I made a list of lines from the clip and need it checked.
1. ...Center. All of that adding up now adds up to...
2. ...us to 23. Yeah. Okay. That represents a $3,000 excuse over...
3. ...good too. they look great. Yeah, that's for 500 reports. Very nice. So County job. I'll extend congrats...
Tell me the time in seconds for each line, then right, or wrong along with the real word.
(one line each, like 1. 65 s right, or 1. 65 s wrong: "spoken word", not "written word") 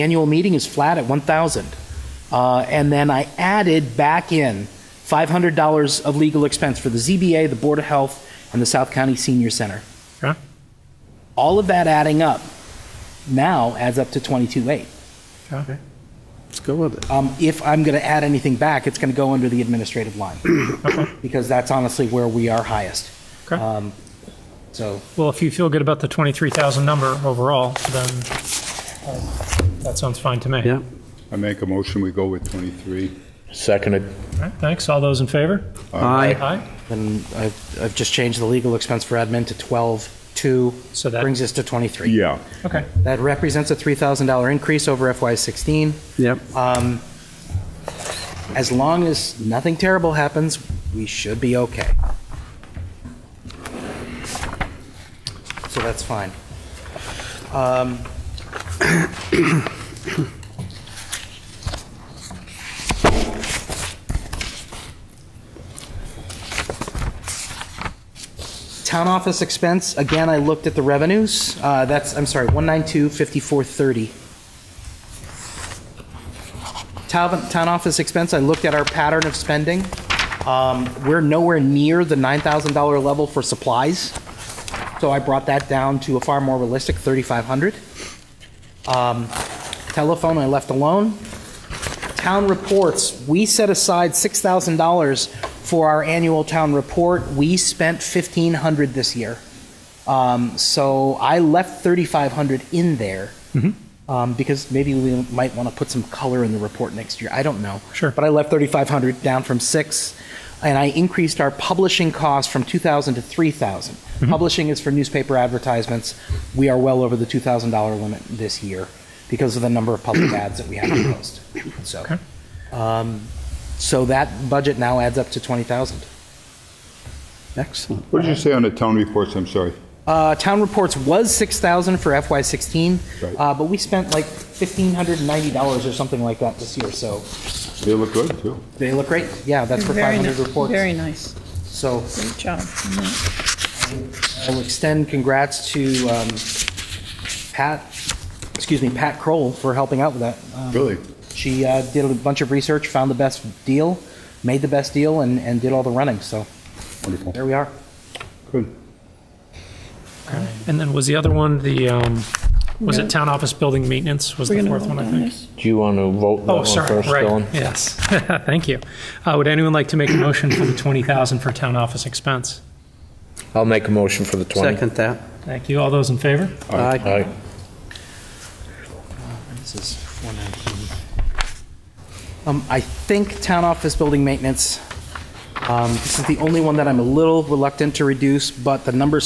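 1. 9 s right
2. 41 s wrong: "increase", not "excuse"
3. 138 s wrong: "Great", not "County".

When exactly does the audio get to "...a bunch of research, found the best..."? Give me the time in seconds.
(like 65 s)
152 s.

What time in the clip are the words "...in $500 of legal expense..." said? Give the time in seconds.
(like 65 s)
4 s.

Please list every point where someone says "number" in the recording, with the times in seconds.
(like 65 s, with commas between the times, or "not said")
26 s, 119 s.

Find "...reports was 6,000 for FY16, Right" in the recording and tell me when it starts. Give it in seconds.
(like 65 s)
130 s.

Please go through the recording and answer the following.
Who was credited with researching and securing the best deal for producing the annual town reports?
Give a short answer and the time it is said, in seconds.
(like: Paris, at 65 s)
Pat Kroll, at 148 s.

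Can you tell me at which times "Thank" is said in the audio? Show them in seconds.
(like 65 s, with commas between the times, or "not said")
34 s, 168 s, 175 s.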